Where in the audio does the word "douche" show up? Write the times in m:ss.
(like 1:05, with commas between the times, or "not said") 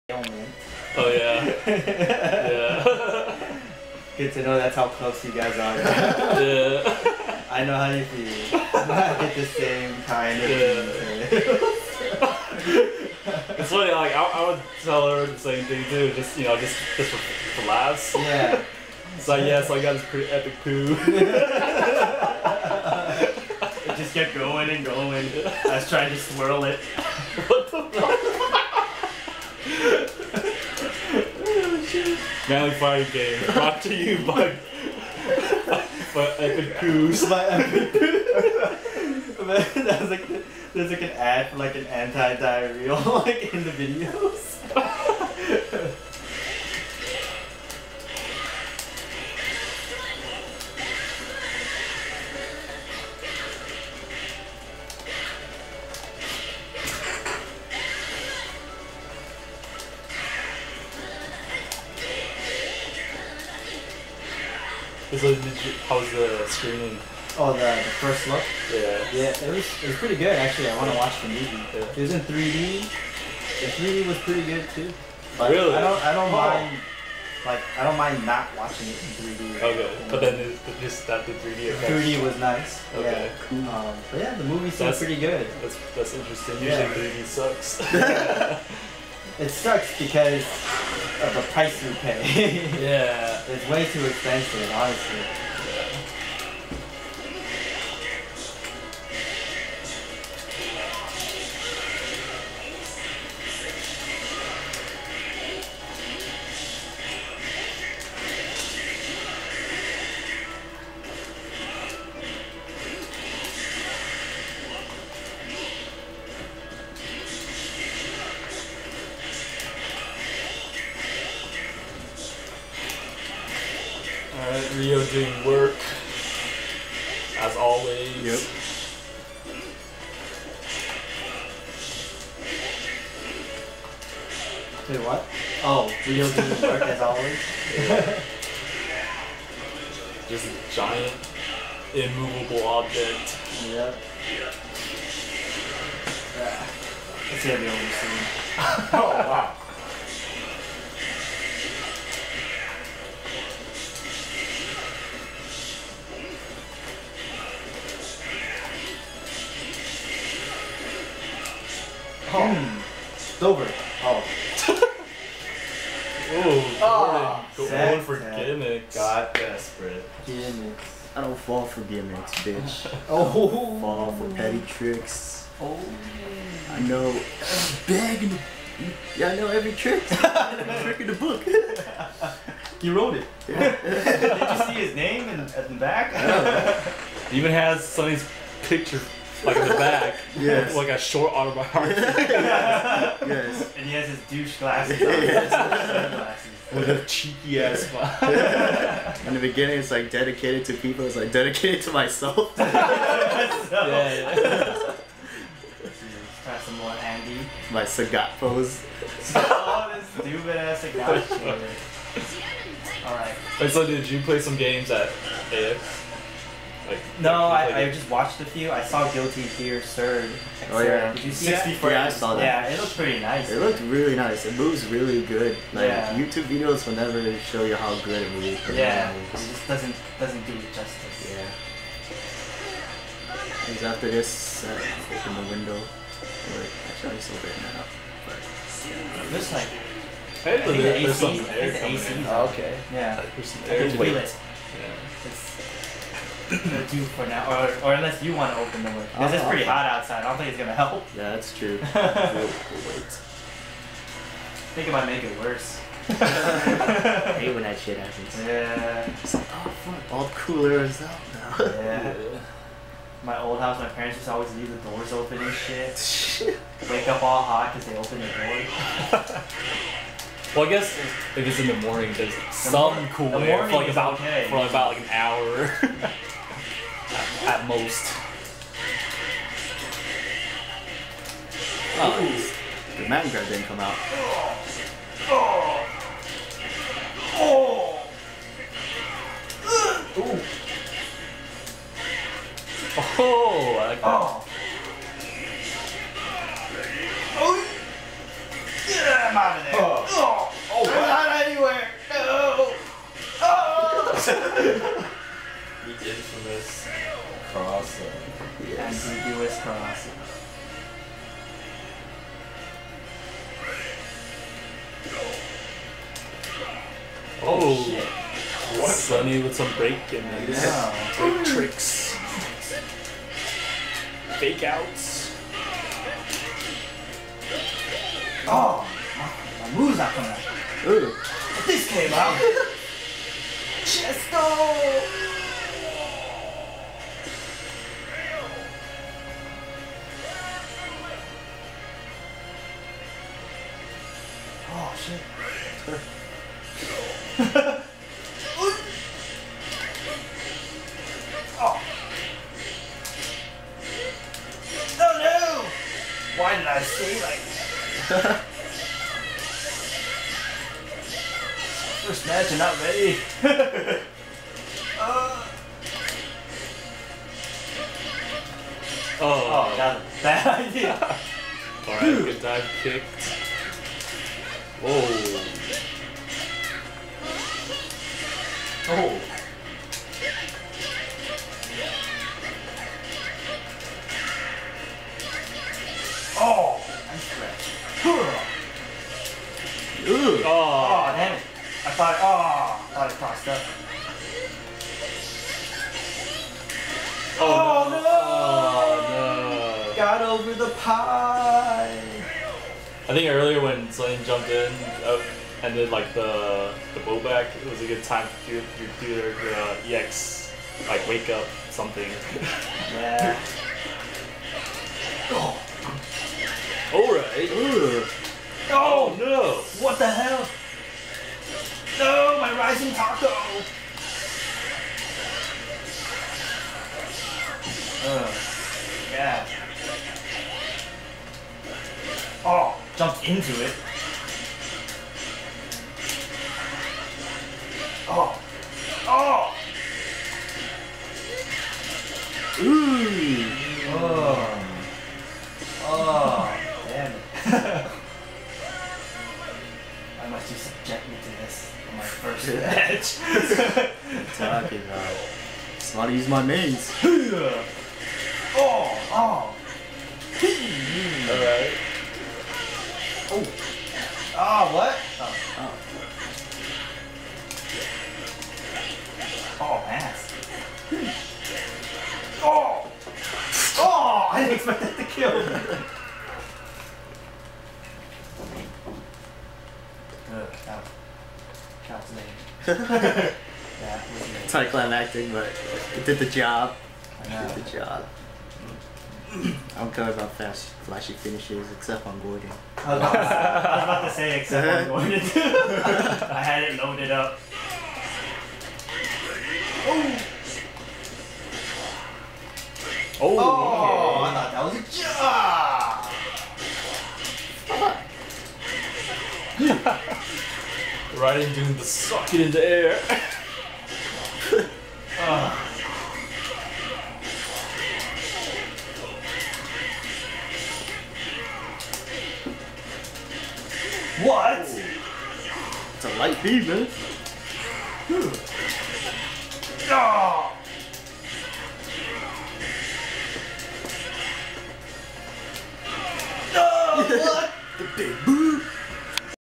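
3:14.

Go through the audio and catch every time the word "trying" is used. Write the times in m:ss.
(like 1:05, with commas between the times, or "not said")
0:25.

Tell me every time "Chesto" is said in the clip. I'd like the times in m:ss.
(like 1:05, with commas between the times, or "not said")
5:33.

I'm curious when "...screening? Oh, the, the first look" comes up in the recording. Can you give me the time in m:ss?
1:06.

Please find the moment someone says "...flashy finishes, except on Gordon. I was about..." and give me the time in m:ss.
8:10.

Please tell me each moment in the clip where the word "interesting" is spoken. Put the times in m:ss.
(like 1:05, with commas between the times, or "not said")
1:26.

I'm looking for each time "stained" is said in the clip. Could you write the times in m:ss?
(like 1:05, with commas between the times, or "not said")
not said.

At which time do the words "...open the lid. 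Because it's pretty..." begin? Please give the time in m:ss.
4:08.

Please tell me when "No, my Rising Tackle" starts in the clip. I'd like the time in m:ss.
7:01.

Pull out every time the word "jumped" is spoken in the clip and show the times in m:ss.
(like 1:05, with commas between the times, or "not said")
6:44, 7:13.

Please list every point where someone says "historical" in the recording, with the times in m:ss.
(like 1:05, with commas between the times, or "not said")
not said.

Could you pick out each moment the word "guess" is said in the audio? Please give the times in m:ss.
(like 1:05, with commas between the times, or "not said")
4:30.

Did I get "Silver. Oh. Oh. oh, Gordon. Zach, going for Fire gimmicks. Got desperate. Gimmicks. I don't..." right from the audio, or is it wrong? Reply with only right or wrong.
wrong.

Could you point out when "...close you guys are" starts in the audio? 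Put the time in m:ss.
0:04.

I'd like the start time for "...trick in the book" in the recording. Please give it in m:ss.
3:00.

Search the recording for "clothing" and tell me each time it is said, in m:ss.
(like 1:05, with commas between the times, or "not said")
not said.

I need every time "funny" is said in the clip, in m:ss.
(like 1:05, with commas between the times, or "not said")
0:13.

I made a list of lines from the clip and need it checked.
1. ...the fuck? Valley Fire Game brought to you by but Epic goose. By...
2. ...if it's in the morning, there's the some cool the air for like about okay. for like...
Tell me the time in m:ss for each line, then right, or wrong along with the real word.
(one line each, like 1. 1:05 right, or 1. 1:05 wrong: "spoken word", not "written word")
1. 0:27 right
2. 4:30 right.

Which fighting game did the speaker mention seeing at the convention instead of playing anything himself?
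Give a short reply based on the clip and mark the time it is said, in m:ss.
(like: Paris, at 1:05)
Guilty Gear, at 3:39.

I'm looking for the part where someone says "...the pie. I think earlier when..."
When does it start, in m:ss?
6:40.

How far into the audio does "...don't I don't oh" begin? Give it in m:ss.
1:15.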